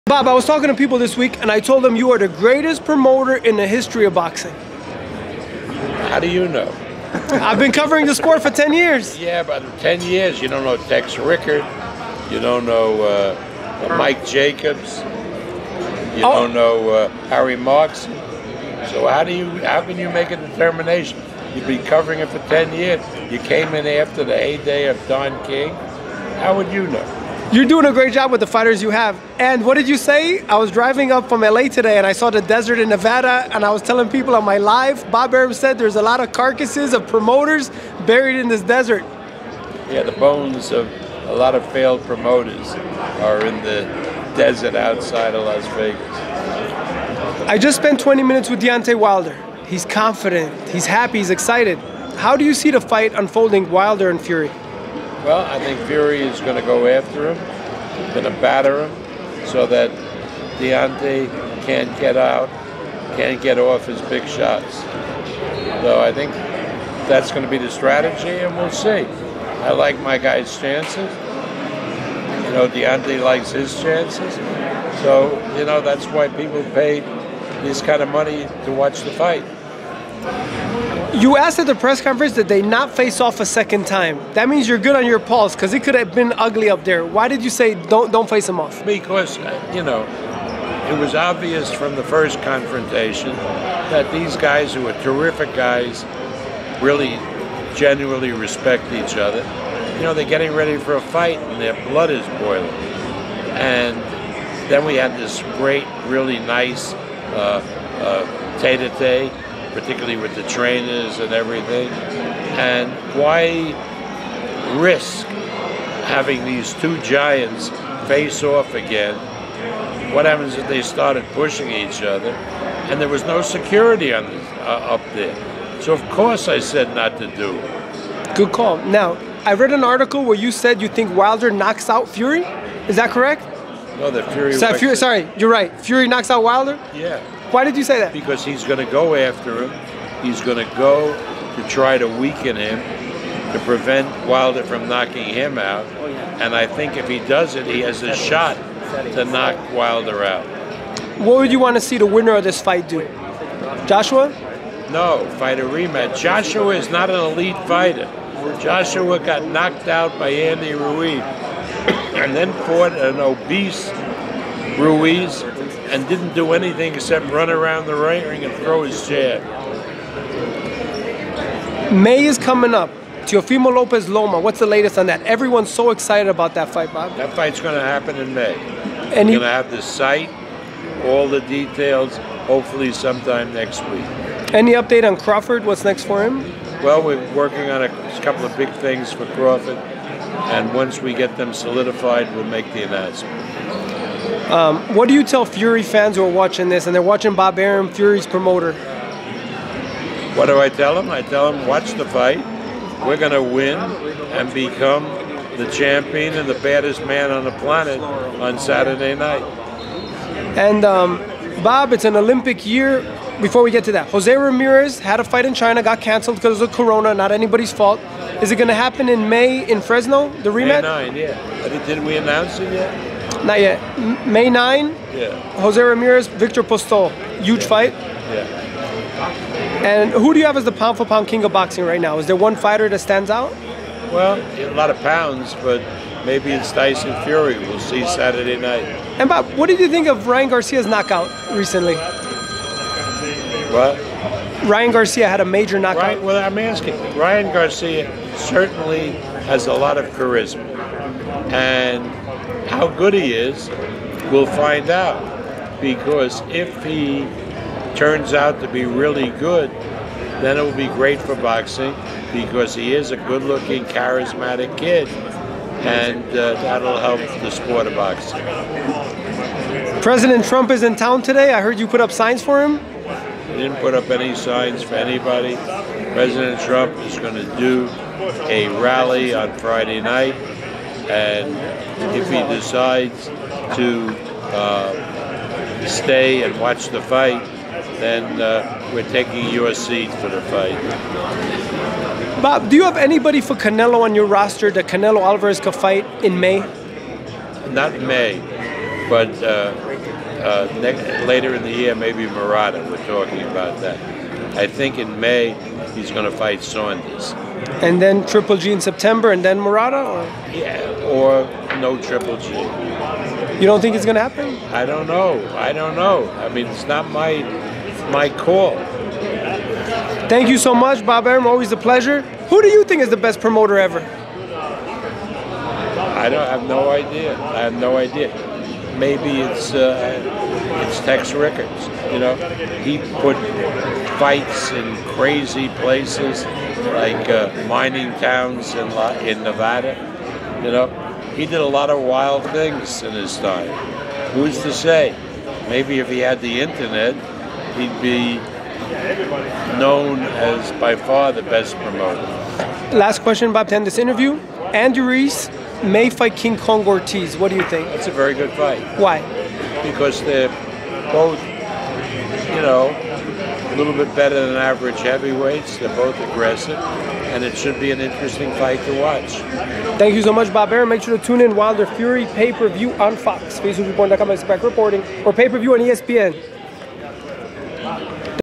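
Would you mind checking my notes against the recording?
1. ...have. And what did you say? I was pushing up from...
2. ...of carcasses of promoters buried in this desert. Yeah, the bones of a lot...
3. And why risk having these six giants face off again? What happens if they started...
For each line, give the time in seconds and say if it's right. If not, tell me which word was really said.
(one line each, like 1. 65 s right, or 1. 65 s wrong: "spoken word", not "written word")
1. 28 s wrong: "driving", not "pushing"
2. 36 s right
3. 112 s wrong: "two", not "six".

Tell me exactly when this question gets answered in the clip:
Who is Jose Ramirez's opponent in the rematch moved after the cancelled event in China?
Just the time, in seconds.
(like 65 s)
226 s.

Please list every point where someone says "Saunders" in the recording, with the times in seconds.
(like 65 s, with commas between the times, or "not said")
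306 s.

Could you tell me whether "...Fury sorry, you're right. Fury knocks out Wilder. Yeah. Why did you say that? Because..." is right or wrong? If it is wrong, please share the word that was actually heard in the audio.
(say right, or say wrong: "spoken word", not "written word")
right.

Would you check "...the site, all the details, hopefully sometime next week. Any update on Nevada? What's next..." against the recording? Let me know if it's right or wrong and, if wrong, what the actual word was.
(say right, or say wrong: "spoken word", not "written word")
wrong: "Crawford", not "Nevada".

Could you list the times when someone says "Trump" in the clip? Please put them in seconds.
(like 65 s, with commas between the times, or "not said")
270 s, 276 s.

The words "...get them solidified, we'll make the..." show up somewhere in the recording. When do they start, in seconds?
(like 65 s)
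191 s.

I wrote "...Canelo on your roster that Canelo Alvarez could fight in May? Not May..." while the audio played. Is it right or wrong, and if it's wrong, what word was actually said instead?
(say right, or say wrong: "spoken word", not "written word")
right.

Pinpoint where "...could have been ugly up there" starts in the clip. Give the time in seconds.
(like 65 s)
85 s.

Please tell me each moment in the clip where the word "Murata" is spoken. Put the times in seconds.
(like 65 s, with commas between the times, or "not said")
302 s, 309 s.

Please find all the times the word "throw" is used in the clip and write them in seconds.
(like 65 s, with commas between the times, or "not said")
168 s.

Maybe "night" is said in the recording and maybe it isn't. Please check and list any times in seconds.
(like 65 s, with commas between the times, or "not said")
209 s, 238 s, 280 s.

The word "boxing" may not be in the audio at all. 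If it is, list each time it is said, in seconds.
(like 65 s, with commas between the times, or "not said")
4 s, 231 s, 261 s, 267 s.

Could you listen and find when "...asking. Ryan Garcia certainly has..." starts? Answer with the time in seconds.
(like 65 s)
246 s.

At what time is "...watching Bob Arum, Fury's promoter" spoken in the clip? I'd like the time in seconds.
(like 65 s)
197 s.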